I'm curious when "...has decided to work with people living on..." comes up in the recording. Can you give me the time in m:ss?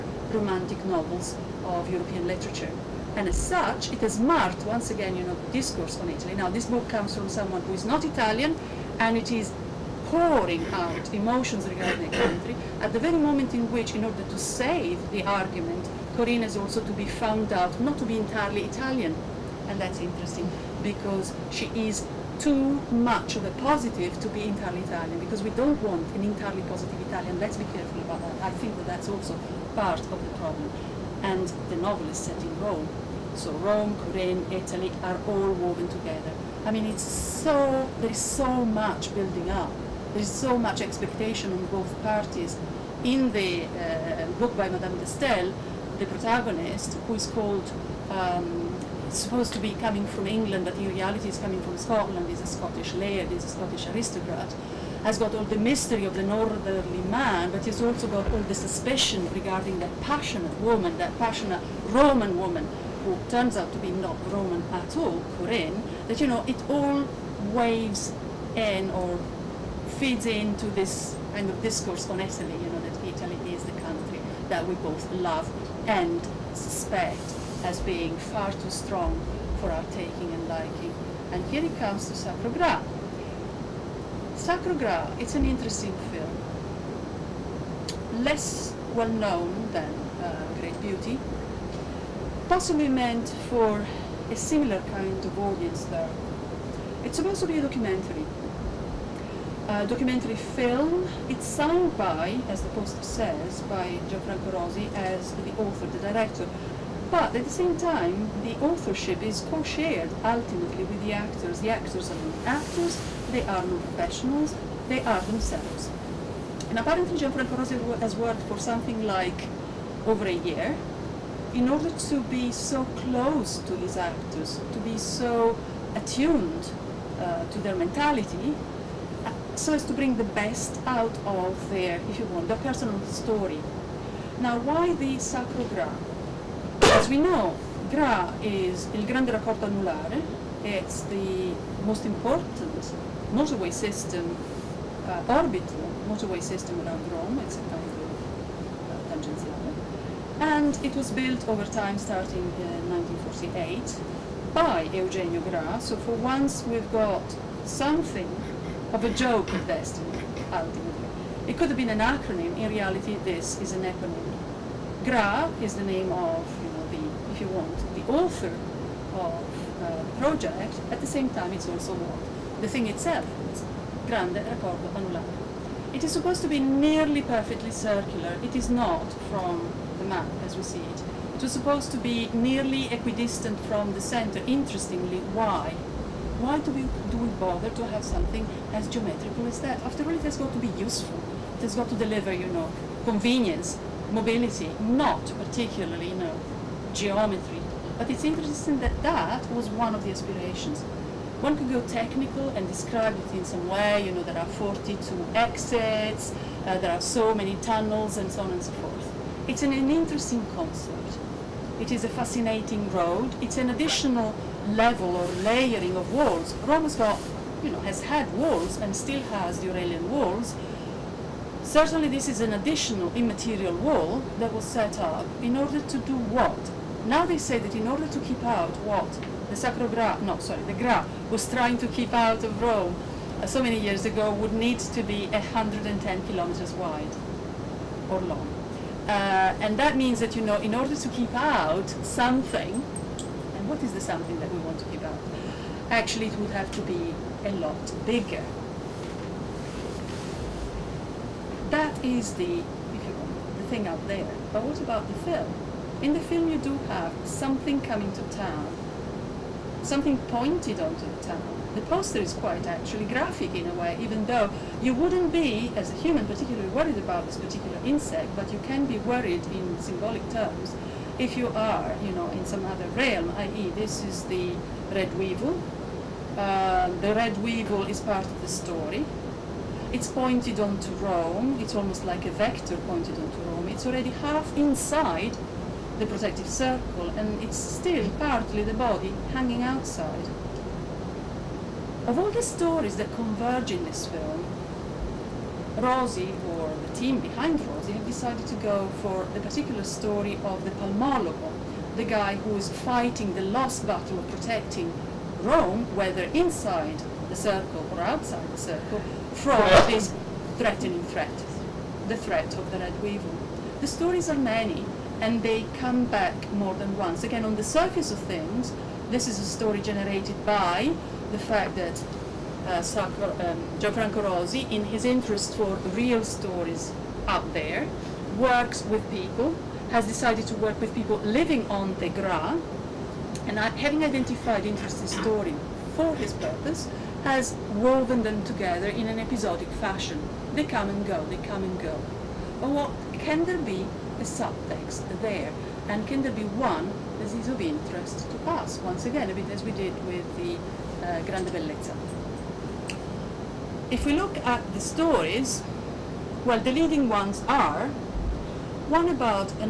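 5:29.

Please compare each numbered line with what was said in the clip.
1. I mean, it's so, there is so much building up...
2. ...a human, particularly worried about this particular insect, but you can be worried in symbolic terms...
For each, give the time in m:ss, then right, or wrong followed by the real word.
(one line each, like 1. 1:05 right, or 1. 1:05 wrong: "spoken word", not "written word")
1. 0:36 right
2. 4:25 right.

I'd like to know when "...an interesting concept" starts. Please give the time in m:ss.
3:29.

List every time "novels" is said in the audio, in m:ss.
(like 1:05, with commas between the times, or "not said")
0:00, 0:31.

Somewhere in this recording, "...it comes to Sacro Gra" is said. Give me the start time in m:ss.
1:21.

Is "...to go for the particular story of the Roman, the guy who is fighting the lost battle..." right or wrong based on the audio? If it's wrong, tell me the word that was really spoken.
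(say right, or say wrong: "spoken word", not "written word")
wrong: "Palmologo", not "Roman".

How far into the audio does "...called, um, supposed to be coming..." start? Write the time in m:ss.
0:47.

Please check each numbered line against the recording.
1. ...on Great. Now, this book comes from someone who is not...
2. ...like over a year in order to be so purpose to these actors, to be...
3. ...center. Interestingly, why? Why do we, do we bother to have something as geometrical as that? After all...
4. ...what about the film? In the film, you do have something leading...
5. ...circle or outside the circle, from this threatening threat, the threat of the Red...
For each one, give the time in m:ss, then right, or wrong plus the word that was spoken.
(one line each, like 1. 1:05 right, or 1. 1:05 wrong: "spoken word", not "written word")
1. 0:06 wrong: "Italy", not "Great"
2. 1:59 wrong: "close", not "purpose"
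3. 3:04 right
4. 4:14 wrong: "coming", not "leading"
5. 5:07 right.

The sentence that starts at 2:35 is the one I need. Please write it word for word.
So for once, we've got something of a joke at best, ultimately.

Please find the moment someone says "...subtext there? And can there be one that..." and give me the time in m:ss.
5:44.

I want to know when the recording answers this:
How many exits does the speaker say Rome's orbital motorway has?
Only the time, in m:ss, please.
3:24.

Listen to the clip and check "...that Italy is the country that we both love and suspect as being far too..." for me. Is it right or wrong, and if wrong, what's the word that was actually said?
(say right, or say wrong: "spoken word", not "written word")
right.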